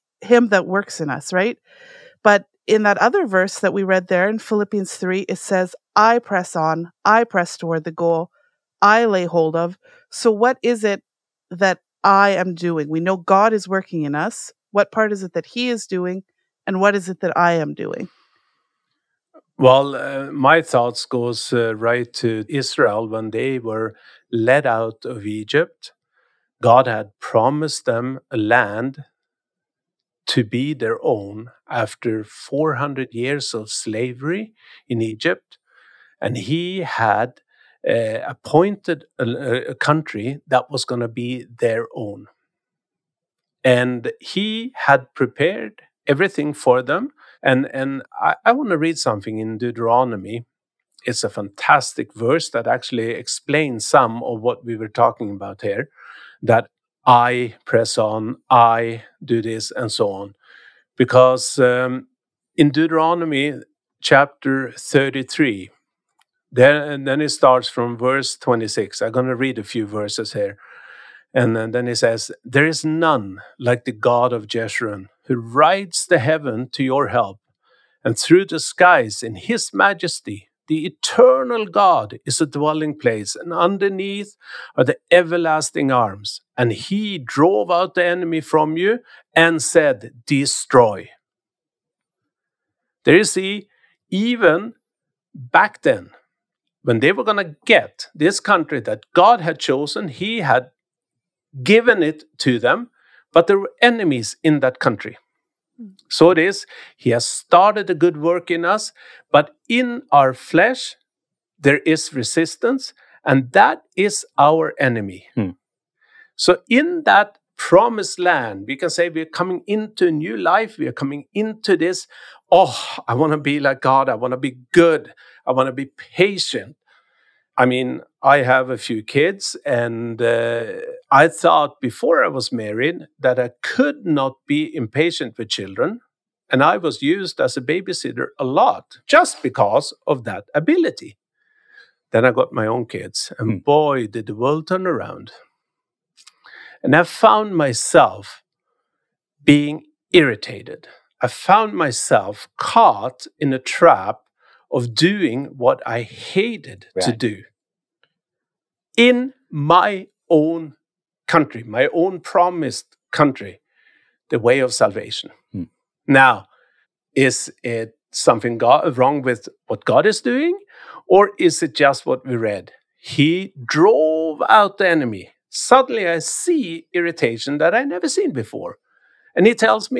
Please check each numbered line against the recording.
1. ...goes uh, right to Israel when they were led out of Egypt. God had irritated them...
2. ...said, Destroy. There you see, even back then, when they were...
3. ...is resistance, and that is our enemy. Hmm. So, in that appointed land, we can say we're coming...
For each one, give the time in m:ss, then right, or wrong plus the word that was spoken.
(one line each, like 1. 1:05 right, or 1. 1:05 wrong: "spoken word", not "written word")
1. 0:21 wrong: "promised", not "irritated"
2. 1:29 right
3. 1:51 wrong: "promised", not "appointed".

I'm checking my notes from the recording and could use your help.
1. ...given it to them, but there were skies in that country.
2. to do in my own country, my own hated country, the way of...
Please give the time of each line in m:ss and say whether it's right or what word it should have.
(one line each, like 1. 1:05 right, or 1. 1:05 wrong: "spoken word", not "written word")
1. 1:41 wrong: "enemies", not "skies"
2. 2:37 wrong: "promised", not "hated".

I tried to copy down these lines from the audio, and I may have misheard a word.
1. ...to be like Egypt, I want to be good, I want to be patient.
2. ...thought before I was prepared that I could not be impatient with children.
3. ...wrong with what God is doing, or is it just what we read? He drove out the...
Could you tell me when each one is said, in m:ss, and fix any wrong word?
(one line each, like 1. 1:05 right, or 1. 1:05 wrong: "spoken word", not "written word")
1. 2:03 wrong: "God", not "Egypt"
2. 2:11 wrong: "married", not "prepared"
3. 2:48 right.